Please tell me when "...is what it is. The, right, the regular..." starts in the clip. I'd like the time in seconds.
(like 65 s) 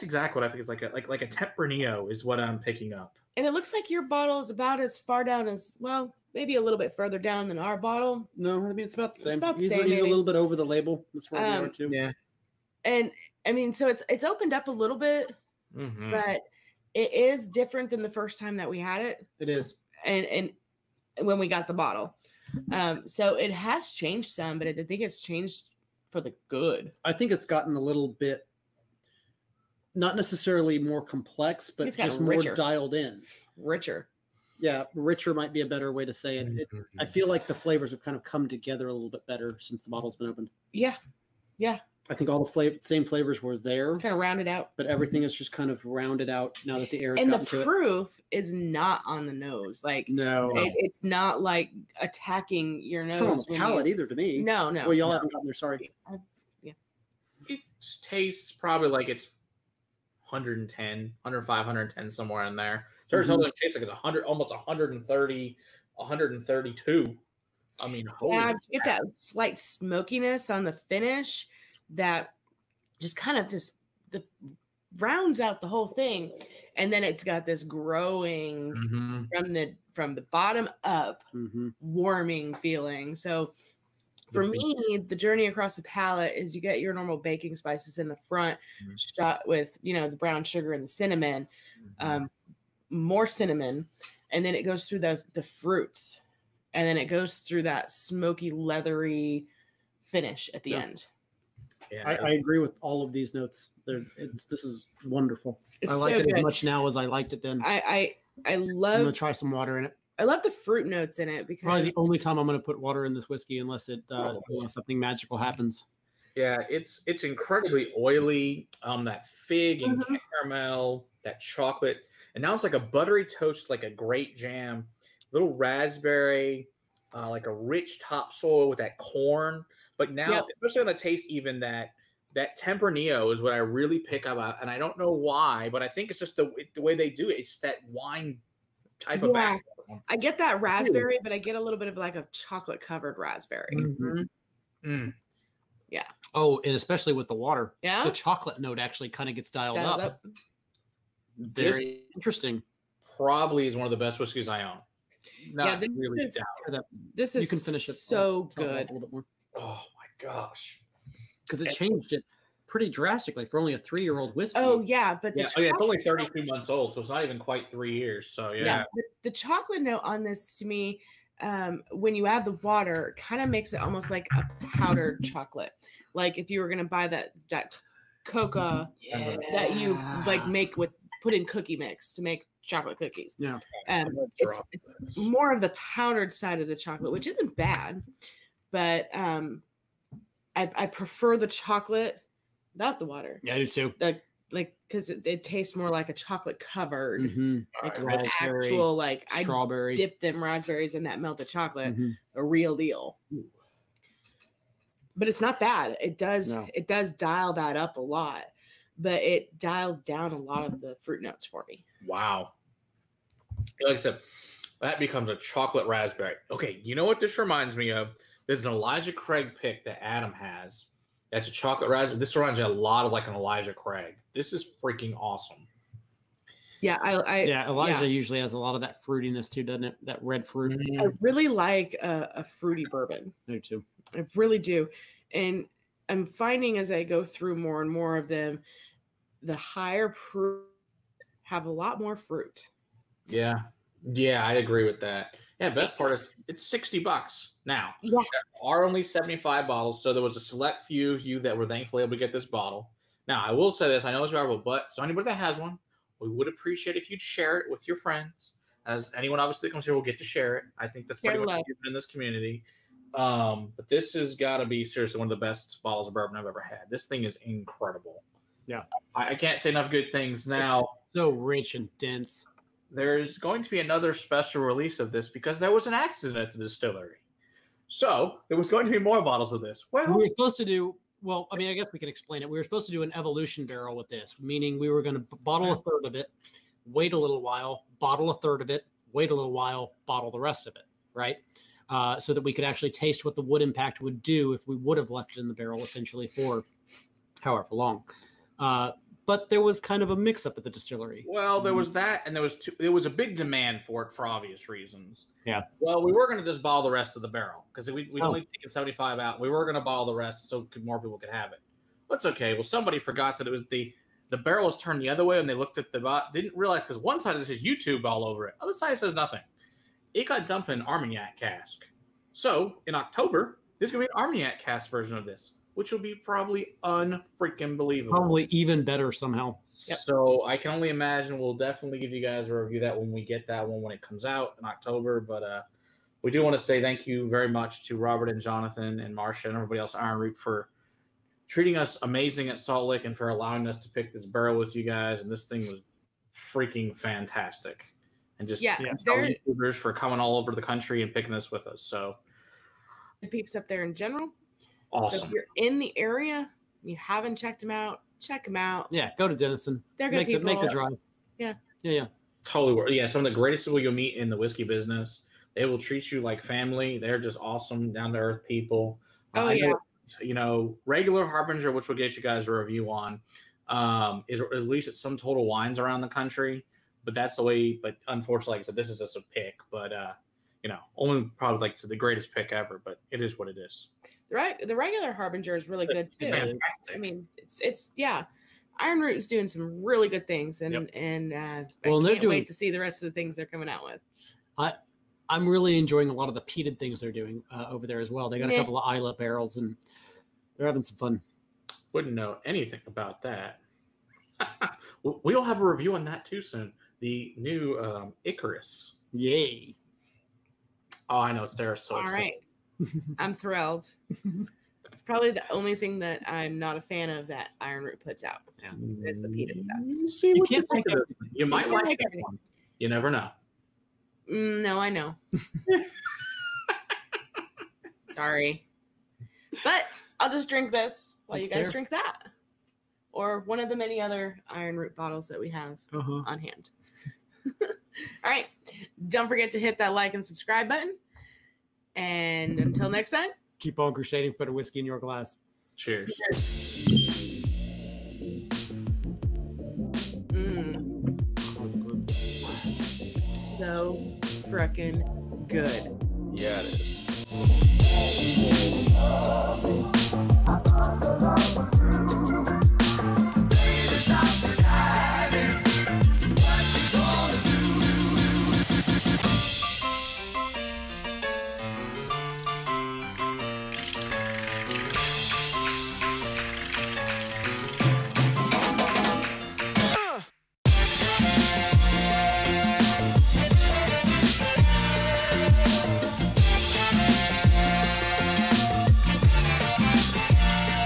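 383 s.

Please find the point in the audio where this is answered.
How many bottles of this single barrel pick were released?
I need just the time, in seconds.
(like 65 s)
249 s.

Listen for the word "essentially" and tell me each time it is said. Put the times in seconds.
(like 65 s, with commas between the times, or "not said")
295 s.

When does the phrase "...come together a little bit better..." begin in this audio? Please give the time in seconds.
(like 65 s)
38 s.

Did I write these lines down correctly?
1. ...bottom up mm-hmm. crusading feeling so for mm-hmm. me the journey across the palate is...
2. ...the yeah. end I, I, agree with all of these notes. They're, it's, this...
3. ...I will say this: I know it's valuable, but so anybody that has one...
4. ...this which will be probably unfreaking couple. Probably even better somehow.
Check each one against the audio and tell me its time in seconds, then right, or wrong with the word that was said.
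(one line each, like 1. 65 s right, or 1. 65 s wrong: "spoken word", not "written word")
1. 80 s wrong: "warming", not "crusading"
2. 100 s right
3. 253 s right
4. 325 s wrong: "believable", not "couple".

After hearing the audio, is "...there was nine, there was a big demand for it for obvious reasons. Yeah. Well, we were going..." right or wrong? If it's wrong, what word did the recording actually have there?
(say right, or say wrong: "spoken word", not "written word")
wrong: "two", not "nine".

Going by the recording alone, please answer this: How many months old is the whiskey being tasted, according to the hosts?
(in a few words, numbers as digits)
32.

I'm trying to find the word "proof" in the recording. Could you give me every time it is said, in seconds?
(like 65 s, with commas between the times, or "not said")
47 s, 240 s.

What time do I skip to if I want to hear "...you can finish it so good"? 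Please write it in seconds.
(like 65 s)
157 s.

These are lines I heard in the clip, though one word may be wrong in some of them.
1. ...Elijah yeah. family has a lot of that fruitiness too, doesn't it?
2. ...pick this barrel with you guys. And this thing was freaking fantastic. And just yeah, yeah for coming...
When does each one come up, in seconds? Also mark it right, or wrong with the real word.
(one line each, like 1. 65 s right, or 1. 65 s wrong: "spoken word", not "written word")
1. 227 s wrong: "usually", not "family"
2. 343 s right.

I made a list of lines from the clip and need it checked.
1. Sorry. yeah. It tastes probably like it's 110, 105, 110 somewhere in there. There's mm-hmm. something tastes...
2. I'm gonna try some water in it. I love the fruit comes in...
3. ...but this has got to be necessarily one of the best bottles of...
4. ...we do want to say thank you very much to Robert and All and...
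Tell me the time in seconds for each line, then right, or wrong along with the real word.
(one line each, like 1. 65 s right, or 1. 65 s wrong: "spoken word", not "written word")
1. 55 s right
2. 108 s wrong: "notes", not "comes"
3. 263 s wrong: "seriously", not "necessarily"
4. 336 s wrong: "Jonathan", not "All".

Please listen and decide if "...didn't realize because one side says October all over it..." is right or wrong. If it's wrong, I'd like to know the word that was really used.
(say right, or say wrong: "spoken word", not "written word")
wrong: "YouTube", not "October".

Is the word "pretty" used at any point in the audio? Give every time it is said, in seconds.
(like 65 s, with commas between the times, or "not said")
162 s, 261 s.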